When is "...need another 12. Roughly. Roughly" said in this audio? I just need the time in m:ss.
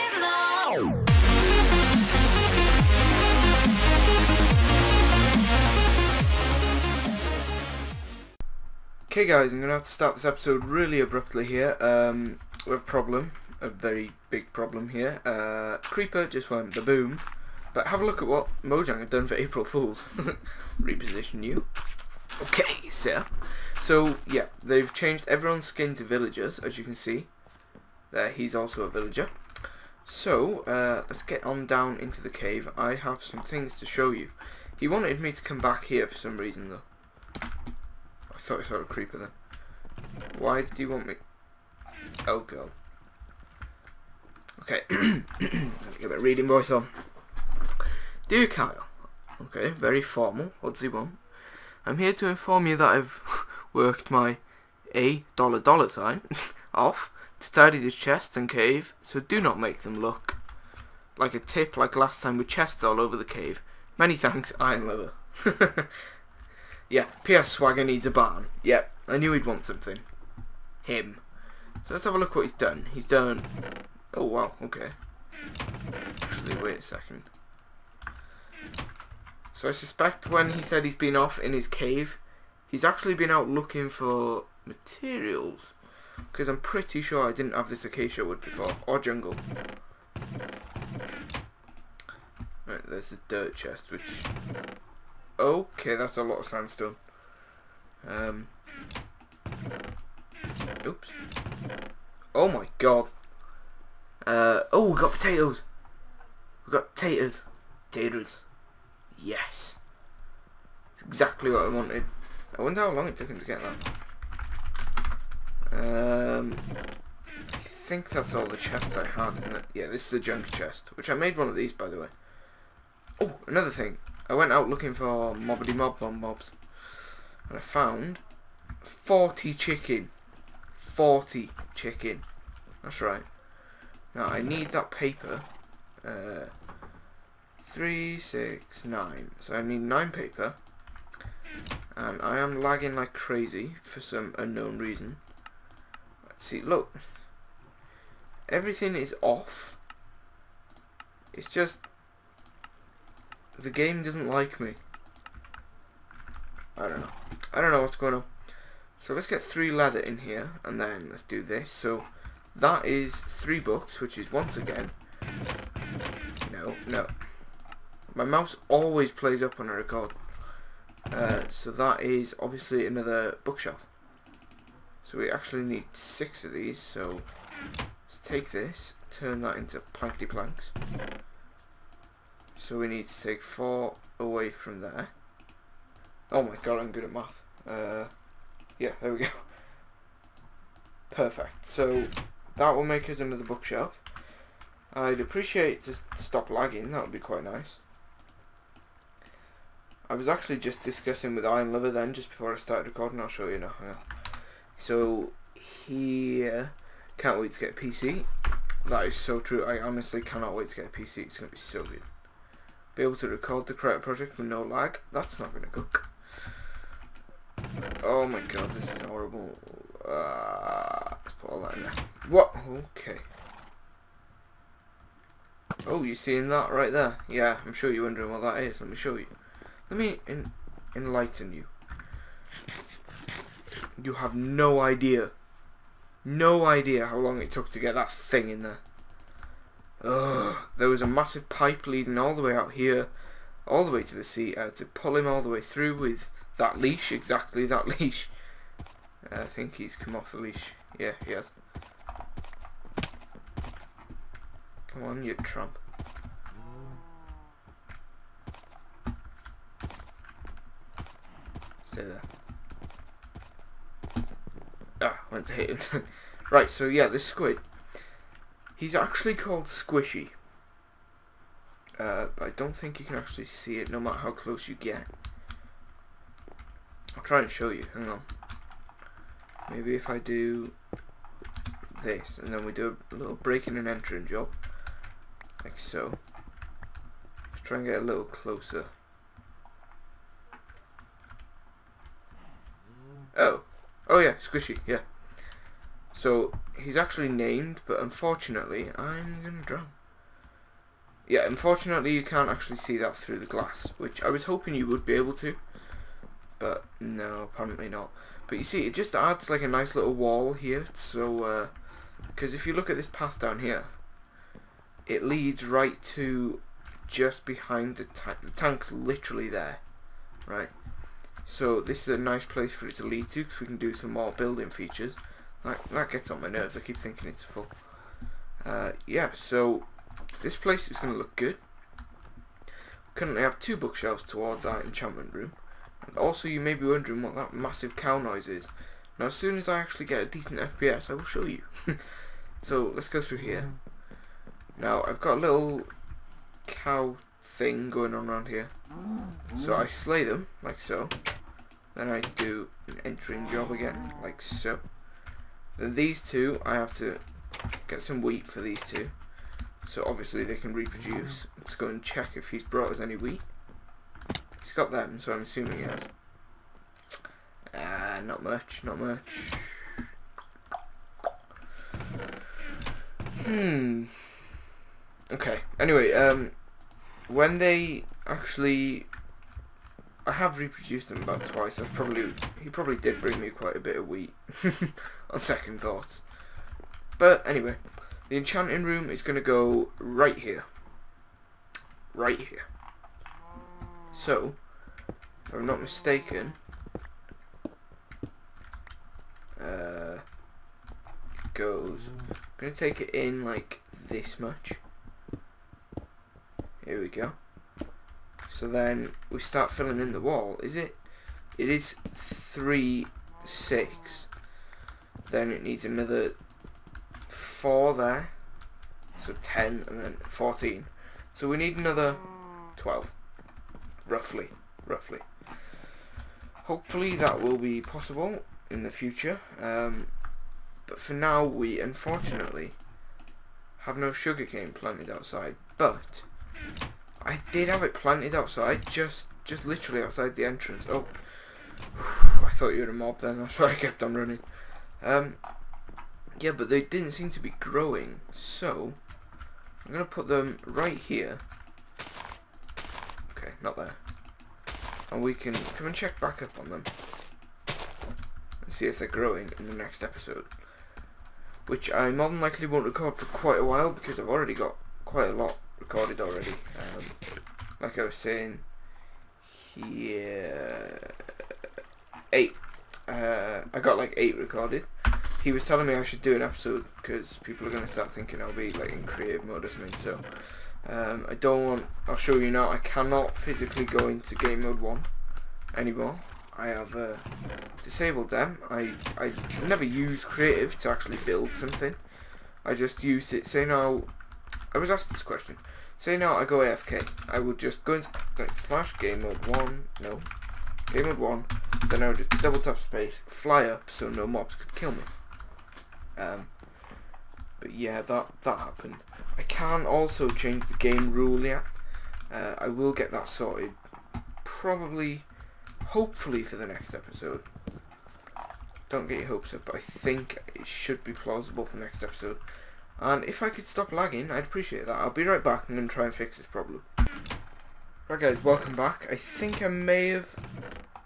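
7:01.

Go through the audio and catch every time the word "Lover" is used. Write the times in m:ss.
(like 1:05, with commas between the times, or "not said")
1:04, 3:21.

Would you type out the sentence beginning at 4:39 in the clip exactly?
Maybe if I do this, and then we do a little breaking and entering job.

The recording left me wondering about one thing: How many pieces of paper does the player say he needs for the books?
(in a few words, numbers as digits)
9.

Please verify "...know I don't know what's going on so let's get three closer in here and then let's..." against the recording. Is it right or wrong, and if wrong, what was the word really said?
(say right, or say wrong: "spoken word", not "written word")
wrong: "leather", not "closer".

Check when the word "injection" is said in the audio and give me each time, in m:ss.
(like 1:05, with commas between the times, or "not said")
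not said.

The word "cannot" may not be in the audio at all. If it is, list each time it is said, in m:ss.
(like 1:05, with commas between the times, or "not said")
3:30, 8:02.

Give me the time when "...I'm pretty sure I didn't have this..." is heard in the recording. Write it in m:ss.
1:26.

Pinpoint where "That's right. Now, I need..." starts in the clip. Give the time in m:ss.
2:12.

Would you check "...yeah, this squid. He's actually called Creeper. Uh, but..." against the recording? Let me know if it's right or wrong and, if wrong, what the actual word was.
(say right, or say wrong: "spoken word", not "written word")
wrong: "Squishy", not "Creeper".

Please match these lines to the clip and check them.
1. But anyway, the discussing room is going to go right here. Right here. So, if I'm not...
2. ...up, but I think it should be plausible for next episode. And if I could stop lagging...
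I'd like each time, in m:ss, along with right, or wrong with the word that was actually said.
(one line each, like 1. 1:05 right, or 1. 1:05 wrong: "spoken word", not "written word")
1. 6:27 wrong: "enchanting", not "discussing"
2. 8:39 right.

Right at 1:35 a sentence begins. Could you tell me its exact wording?
Okay, that's a lot of sandstone.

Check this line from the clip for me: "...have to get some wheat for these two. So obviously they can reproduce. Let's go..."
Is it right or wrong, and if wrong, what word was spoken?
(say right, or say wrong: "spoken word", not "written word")
right.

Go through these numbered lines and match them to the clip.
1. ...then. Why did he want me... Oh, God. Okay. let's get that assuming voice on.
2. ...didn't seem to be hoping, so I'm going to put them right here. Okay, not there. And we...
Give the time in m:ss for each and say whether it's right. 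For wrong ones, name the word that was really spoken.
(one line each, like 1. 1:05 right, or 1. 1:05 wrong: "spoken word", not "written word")
1. 0:39 wrong: "reading", not "assuming"
2. 7:26 wrong: "growing", not "hoping".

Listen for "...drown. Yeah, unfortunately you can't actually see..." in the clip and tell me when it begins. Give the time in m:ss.
4:59.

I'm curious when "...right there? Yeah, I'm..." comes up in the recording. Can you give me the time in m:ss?
3:46.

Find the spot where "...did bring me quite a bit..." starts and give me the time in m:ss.
6:22.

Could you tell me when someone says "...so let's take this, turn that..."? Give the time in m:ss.
2:56.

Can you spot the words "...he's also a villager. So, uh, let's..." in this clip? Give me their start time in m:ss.
0:28.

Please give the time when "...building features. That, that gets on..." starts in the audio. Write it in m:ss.
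5:24.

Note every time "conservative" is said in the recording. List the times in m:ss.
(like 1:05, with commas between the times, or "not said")
not said.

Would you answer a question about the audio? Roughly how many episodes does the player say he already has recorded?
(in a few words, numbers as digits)
8.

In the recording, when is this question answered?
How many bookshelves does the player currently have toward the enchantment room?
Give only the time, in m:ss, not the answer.
5:33.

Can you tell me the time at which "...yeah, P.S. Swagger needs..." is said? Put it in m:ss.
1:06.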